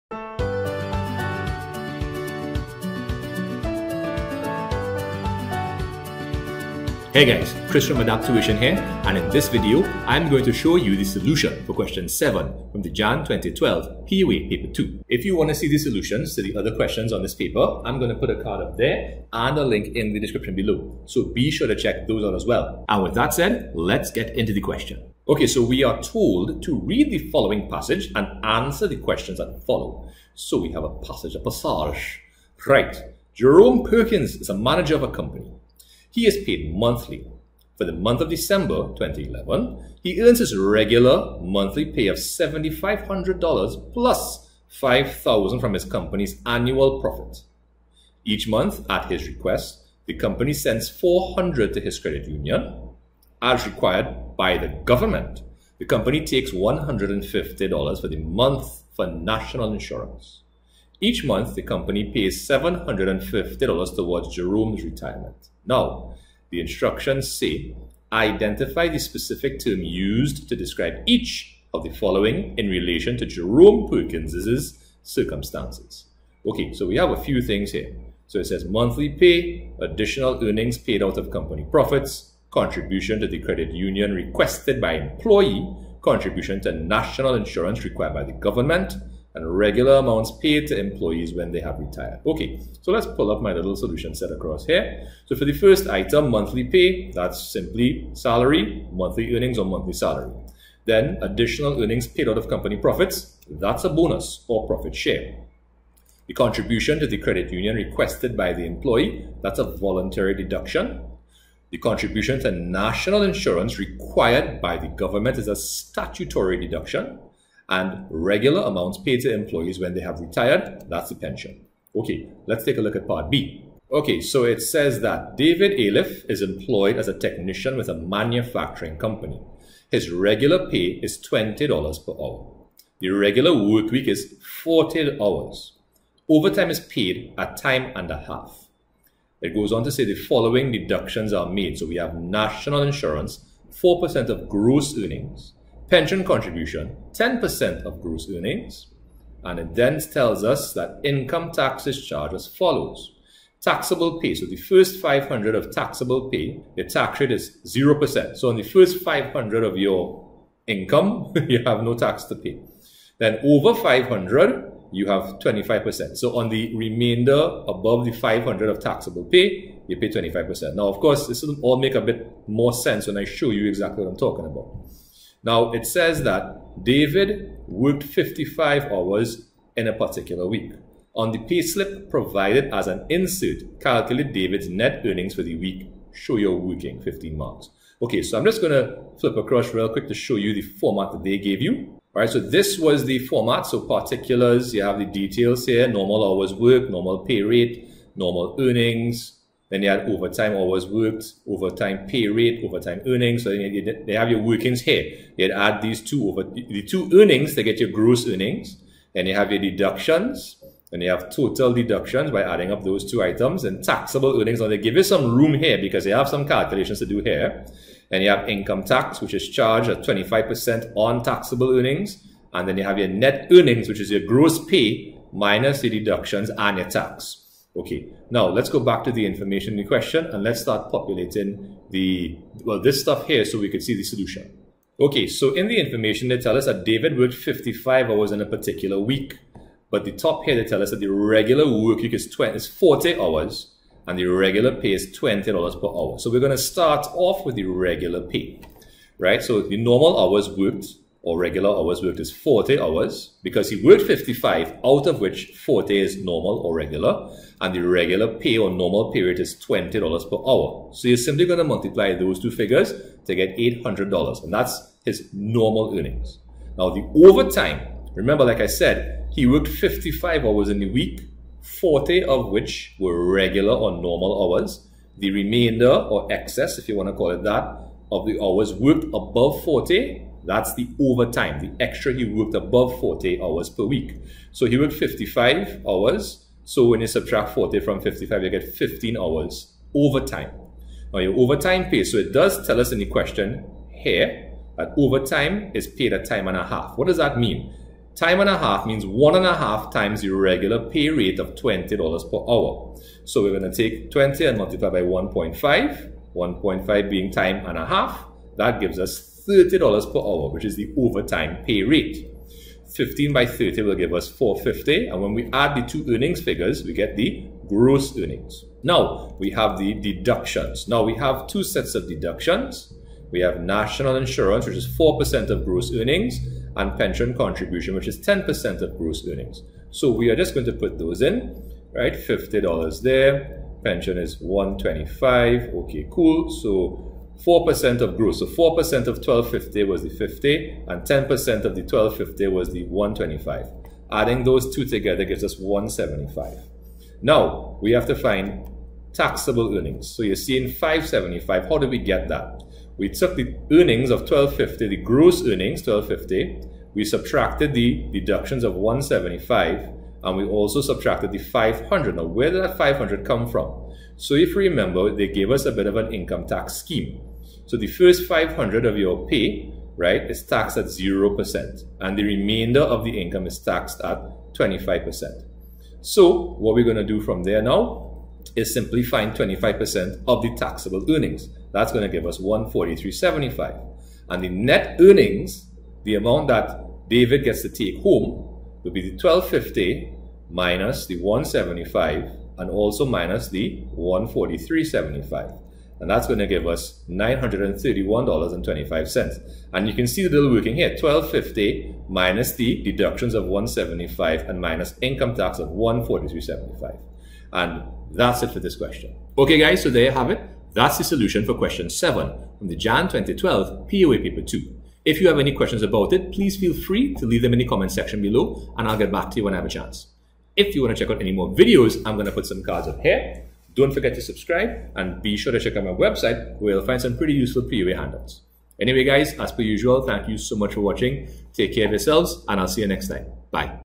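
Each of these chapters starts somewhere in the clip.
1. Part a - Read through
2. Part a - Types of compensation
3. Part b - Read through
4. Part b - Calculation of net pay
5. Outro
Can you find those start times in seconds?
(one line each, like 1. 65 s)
1. 25 s
2. 65 s
3. 123 s
4. 235 s
5. 409 s.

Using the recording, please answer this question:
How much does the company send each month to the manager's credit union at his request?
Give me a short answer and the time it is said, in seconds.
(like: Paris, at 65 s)
400, at 50 s.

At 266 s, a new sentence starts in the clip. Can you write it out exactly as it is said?
Now, the overtime, remember, like I said, he worked 55 hours in the week, 40 of which were regular or normal hours.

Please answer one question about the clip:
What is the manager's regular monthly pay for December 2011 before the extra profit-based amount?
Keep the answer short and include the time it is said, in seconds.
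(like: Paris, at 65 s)
$7,500, at 42 s.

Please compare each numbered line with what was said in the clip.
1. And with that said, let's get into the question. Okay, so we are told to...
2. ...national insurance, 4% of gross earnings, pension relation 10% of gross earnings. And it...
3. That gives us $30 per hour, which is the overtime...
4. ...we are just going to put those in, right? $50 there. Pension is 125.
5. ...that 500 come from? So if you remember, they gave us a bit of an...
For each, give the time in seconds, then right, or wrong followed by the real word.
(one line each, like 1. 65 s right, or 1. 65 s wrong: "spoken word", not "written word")
1. 22 s right
2. 142 s wrong: "contribution", not "relation"
3. 308 s right
4. 330 s right
5. 362 s right.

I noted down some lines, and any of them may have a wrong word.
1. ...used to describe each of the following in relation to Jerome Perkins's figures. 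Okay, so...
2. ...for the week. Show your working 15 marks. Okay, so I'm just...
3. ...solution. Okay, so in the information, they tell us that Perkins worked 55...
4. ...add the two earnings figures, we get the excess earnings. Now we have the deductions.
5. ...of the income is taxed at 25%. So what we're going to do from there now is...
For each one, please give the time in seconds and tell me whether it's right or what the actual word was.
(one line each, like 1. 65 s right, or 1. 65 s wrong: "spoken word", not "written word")
1. 69 s wrong: "circumstances", not "figures"
2. 185 s right
3. 234 s wrong: "David", not "Perkins"
4. 315 s wrong: "gross", not "excess"
5. 372 s right.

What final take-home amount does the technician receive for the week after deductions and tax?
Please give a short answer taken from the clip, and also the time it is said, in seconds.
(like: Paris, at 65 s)
$931.25, at 397 s.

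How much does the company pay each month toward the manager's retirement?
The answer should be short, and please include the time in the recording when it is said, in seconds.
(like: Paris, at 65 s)
$750, at 62 s.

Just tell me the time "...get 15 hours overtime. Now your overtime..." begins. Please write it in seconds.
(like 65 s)
288 s.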